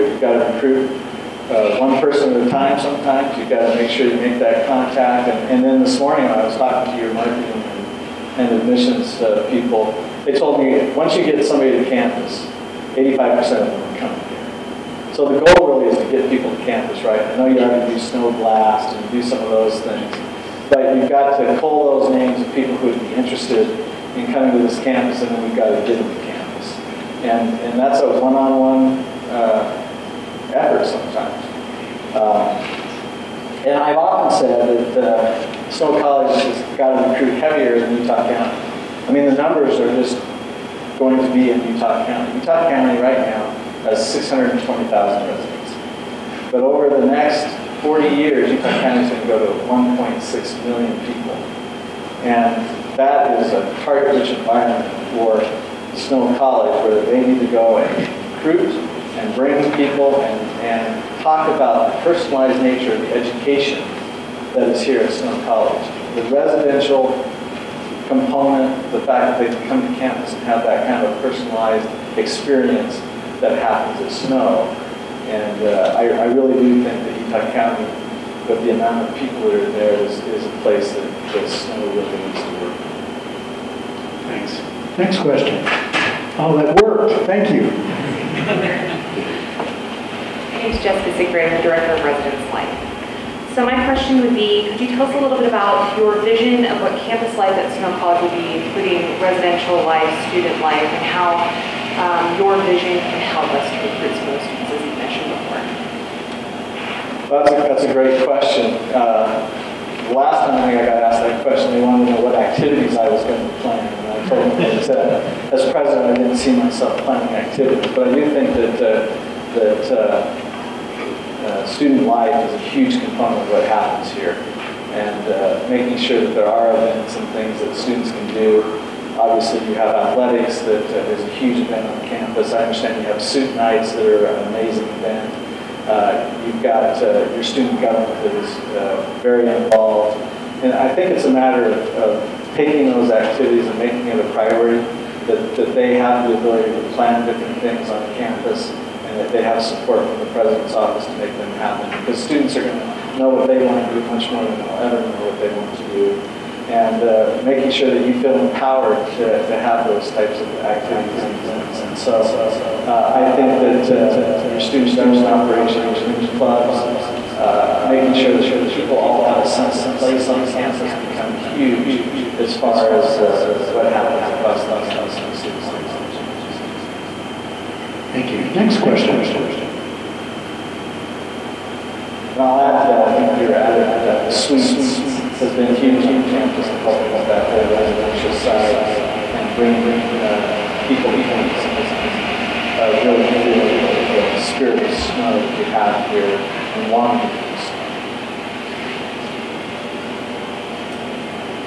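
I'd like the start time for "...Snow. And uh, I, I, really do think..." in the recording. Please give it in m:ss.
1:14.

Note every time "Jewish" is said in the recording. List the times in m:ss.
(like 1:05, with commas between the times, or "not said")
not said.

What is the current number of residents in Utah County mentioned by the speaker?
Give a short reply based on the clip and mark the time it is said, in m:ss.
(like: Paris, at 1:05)
620,000, at 0:44.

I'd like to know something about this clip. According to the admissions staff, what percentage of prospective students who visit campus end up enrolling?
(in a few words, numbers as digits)
85%.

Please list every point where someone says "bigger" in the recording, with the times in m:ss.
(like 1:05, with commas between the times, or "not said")
not said.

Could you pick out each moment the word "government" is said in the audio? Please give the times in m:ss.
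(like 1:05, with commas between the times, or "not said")
2:17, 2:44.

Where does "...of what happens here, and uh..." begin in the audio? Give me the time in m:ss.
2:03.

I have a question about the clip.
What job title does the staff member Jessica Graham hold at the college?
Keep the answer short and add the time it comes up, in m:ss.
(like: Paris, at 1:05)
Director of Residence Life, at 1:31.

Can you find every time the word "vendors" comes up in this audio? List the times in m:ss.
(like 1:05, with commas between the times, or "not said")
not said.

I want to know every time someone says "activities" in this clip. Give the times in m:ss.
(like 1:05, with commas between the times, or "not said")
1:52, 1:57, 2:23, 2:40.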